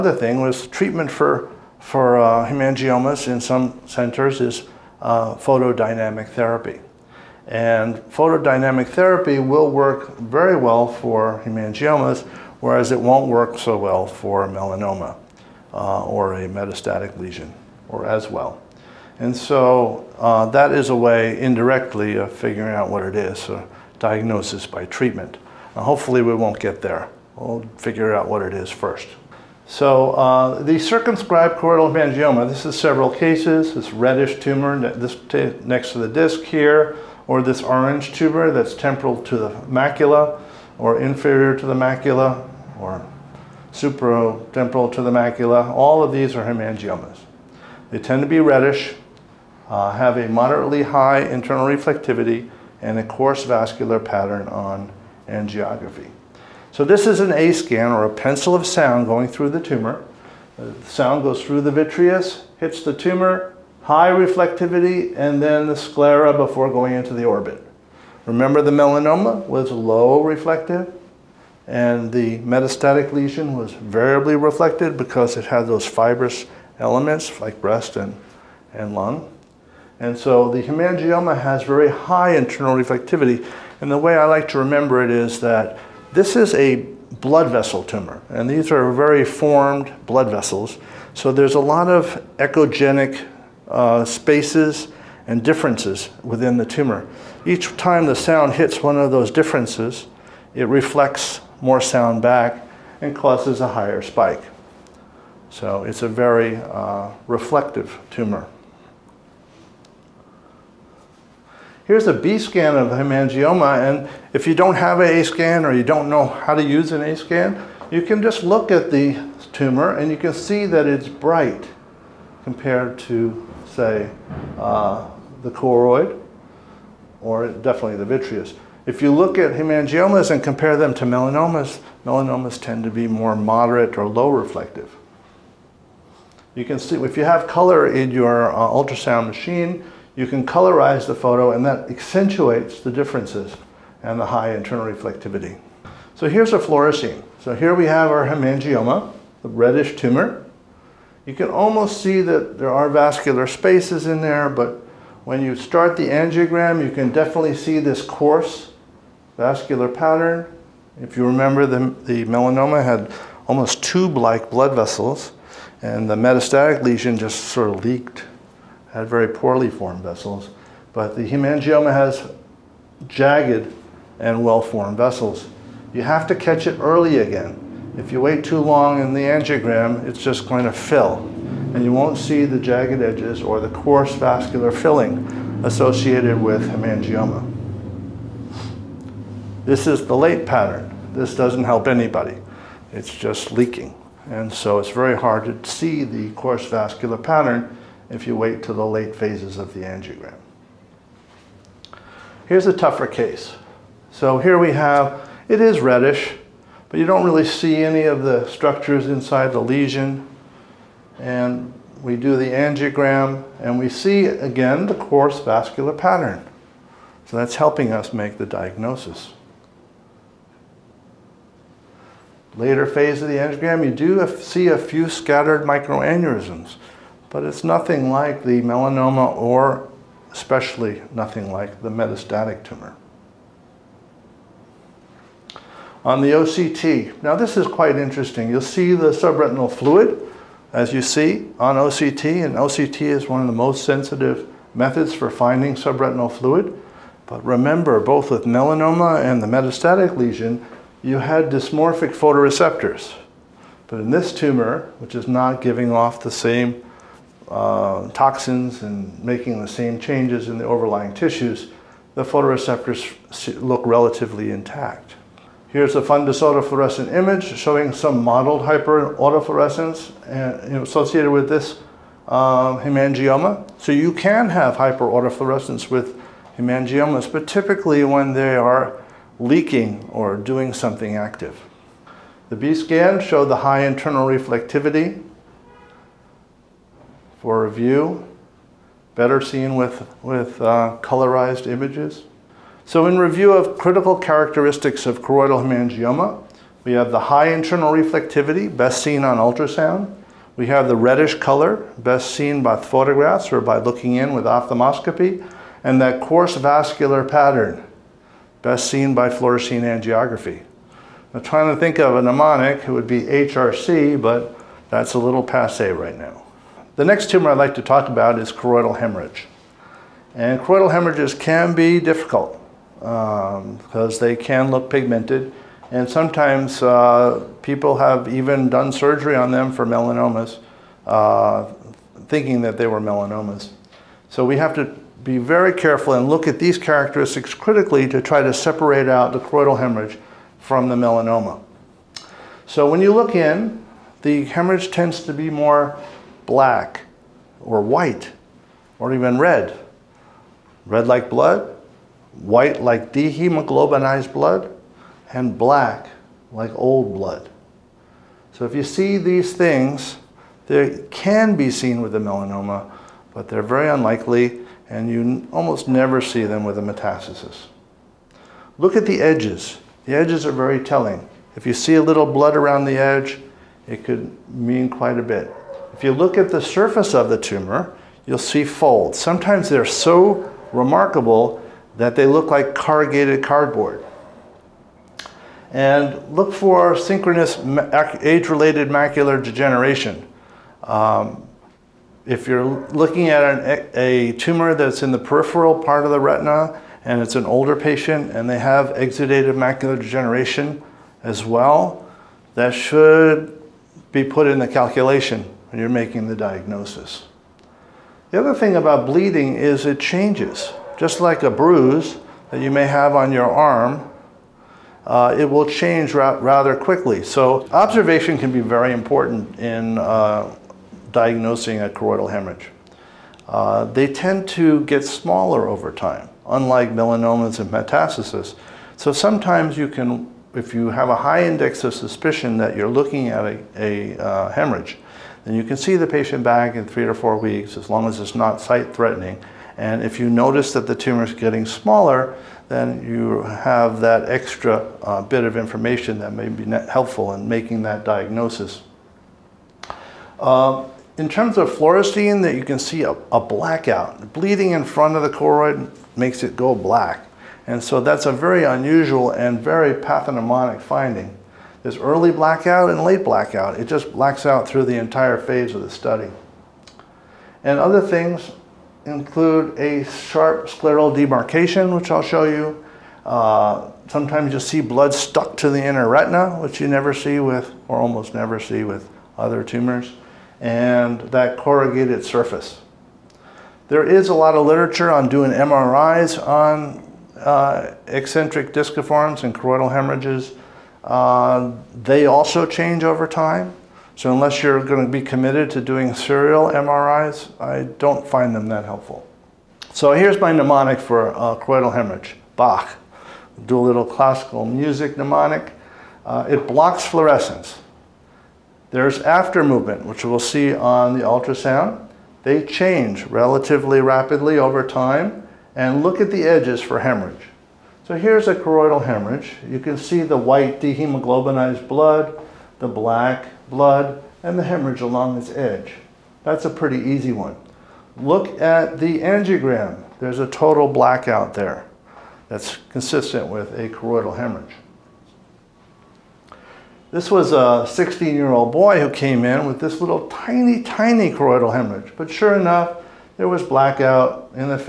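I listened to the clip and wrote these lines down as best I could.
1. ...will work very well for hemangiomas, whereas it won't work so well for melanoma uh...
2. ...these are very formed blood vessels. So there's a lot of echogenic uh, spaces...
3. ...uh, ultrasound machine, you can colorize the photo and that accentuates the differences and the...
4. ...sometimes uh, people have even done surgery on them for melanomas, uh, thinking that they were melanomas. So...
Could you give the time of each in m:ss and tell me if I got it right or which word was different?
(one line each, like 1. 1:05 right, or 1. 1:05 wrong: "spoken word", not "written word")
1. 0:09 right
2. 1:28 right
3. 2:18 right
4. 5:26 right.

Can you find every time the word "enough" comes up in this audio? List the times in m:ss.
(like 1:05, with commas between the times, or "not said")
9:02.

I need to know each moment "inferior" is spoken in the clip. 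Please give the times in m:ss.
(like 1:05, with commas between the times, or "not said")
0:41.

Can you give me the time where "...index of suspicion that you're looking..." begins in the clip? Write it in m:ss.
7:11.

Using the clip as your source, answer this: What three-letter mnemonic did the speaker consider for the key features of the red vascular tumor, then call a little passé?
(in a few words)
HRC.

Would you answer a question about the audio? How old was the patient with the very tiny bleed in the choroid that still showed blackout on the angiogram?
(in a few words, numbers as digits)
16.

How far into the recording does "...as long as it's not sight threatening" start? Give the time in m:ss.
7:17.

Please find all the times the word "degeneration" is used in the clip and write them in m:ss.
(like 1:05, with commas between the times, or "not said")
6:29, 6:39.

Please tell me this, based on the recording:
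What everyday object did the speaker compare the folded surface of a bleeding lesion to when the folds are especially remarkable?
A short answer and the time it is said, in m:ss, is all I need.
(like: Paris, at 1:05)
Corrugated cardboard, at 6:22.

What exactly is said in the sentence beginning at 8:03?
There is a lot of literature on doing MRIs on uh, eccentric disciforms and choroidal hemorrhages uh, they also change over time.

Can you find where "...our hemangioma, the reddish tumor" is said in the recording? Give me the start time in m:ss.
2:28.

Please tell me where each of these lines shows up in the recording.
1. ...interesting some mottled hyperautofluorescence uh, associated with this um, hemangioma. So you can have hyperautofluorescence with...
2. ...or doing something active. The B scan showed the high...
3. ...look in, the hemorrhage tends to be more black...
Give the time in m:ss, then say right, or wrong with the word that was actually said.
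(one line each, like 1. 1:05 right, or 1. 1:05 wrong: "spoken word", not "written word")
1. 4:27 wrong: "showing", not "interesting"
2. 4:40 right
3. 5:43 right.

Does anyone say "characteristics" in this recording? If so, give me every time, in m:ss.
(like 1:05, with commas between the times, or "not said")
4:54, 5:36.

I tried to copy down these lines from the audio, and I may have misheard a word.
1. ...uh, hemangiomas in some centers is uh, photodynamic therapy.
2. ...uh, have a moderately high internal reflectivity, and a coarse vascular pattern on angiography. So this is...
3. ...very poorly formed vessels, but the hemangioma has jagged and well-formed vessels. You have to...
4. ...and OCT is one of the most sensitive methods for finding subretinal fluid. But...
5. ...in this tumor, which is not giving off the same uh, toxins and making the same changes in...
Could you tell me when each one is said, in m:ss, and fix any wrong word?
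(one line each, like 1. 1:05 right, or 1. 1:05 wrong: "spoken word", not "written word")
1. 0:02 right
2. 0:49 right
3. 2:49 right
4. 4:02 right
5. 4:14 right.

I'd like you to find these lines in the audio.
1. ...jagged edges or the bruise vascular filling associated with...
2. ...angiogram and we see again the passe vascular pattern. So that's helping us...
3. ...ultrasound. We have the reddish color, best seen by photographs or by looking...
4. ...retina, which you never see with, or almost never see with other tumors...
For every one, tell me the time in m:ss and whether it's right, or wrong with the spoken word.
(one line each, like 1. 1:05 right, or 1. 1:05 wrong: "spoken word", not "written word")
1. 3:02 wrong: "coarse", not "bruise"
2. 3:32 wrong: "coarse", not "passe"
3. 4:59 right
4. 7:56 right.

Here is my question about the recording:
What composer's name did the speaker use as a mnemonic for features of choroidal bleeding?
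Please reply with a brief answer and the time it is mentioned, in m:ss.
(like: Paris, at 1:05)
Bach, at 8:22.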